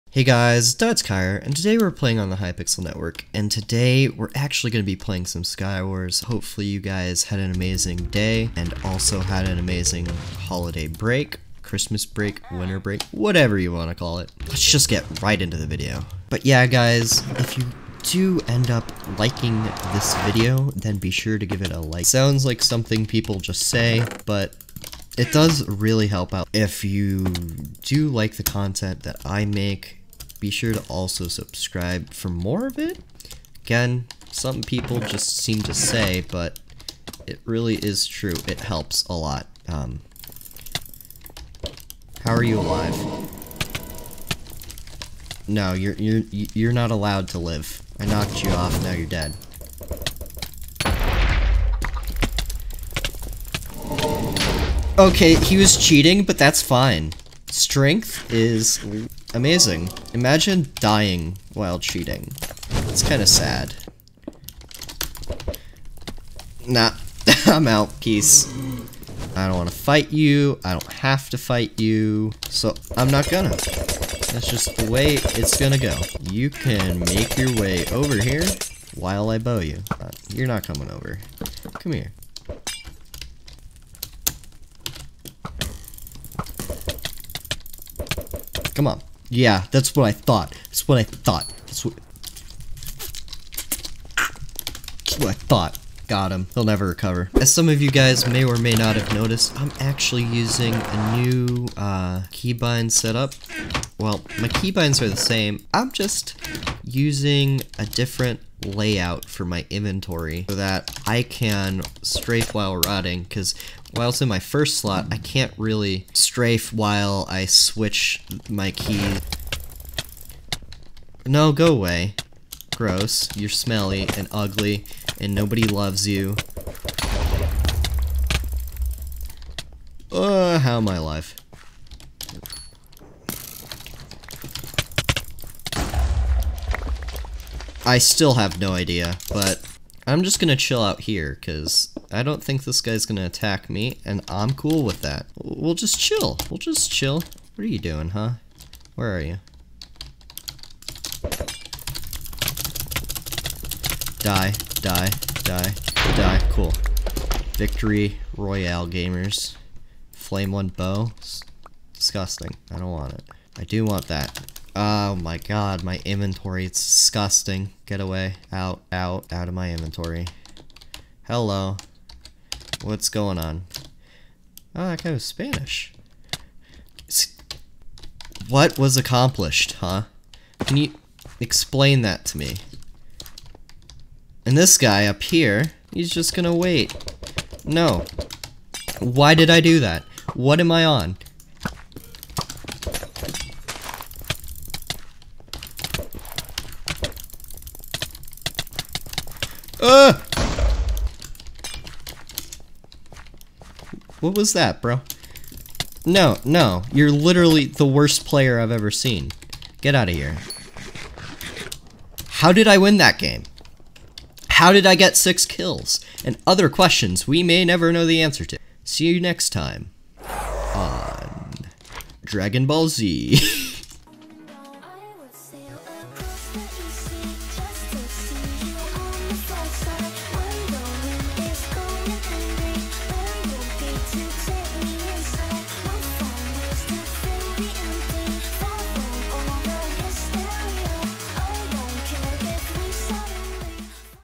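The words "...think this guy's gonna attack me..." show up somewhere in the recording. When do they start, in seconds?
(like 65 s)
142 s.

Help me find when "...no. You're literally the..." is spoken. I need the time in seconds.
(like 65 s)
206 s.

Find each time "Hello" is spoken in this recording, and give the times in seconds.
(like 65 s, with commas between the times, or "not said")
171 s.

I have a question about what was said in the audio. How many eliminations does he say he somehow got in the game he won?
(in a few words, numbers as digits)
6.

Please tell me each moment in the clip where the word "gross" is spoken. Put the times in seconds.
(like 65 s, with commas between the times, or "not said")
122 s.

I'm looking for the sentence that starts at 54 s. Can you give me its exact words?
Okay, he was cheating, but that's fine.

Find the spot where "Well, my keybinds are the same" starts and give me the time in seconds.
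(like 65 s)
103 s.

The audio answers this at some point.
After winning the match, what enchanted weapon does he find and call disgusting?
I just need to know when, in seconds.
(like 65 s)
160 s.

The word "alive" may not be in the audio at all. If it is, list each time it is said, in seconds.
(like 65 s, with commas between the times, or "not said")
42 s, 130 s.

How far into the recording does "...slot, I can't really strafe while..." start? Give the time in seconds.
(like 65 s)
114 s.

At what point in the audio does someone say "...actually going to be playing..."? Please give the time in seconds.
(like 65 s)
4 s.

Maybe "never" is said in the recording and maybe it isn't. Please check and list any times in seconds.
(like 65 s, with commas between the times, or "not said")
96 s, 217 s.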